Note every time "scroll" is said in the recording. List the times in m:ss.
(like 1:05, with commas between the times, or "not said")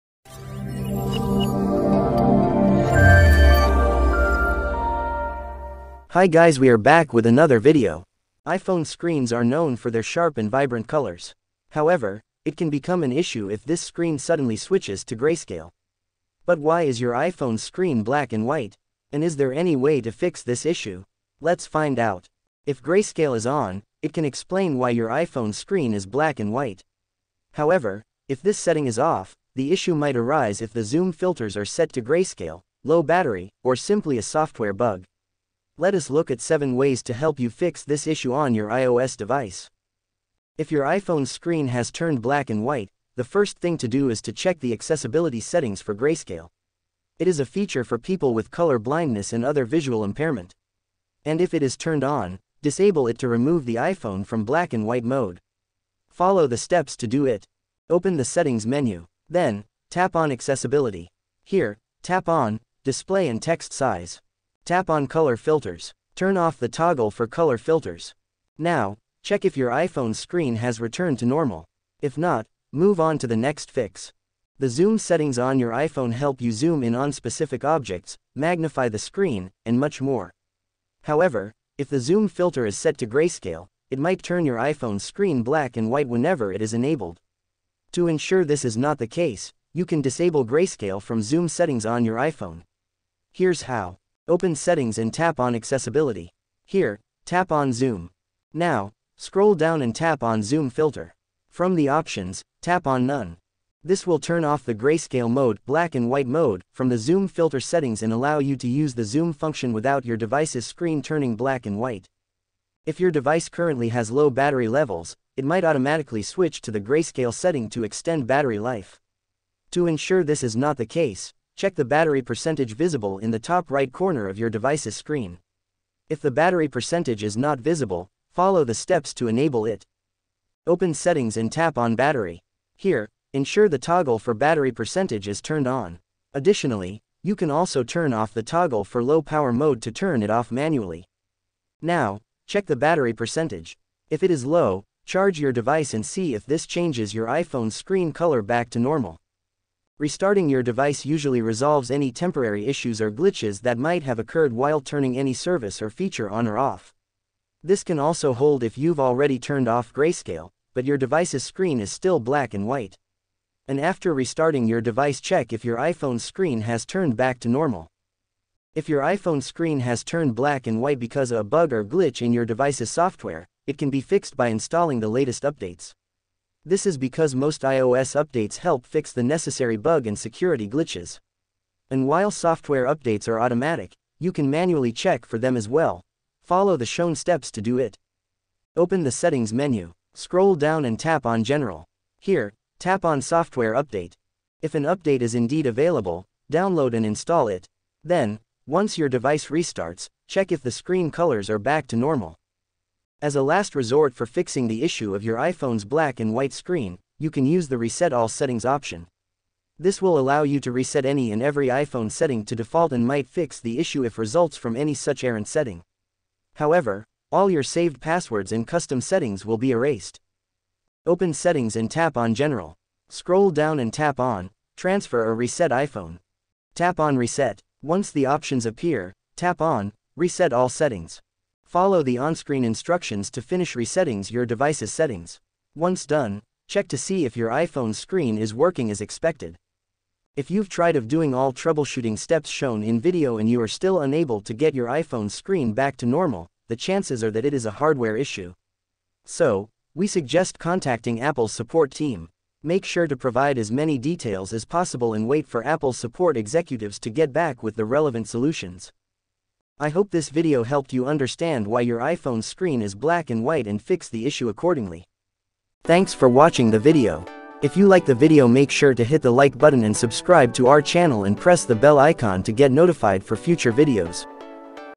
1:39, 3:10, 3:43.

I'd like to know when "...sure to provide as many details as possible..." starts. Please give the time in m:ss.
4:12.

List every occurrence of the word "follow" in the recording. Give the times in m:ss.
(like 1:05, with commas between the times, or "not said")
0:56, 2:08, 3:06, 3:51.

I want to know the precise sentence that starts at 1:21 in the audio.
However, if the zoom filter is set to grayscale, it might turn your iPhone screen black and white whenever it is enabled.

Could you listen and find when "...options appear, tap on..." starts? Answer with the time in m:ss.
3:48.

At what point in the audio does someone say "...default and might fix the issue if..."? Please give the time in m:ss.
3:32.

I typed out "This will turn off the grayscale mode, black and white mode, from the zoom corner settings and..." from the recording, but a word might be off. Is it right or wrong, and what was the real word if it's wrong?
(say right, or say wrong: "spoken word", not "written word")
wrong: "filter", not "corner".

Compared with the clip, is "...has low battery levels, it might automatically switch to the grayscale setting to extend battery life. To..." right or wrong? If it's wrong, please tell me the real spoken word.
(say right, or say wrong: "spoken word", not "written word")
right.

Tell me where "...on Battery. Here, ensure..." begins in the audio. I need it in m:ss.
2:11.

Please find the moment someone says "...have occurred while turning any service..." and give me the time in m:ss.
2:34.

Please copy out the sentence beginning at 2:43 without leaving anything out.
And after restarting your device check if your iPhone screen has turned back to normal.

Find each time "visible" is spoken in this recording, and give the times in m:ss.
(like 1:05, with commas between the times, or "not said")
2:02, 2:07.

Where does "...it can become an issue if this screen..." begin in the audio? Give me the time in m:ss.
0:12.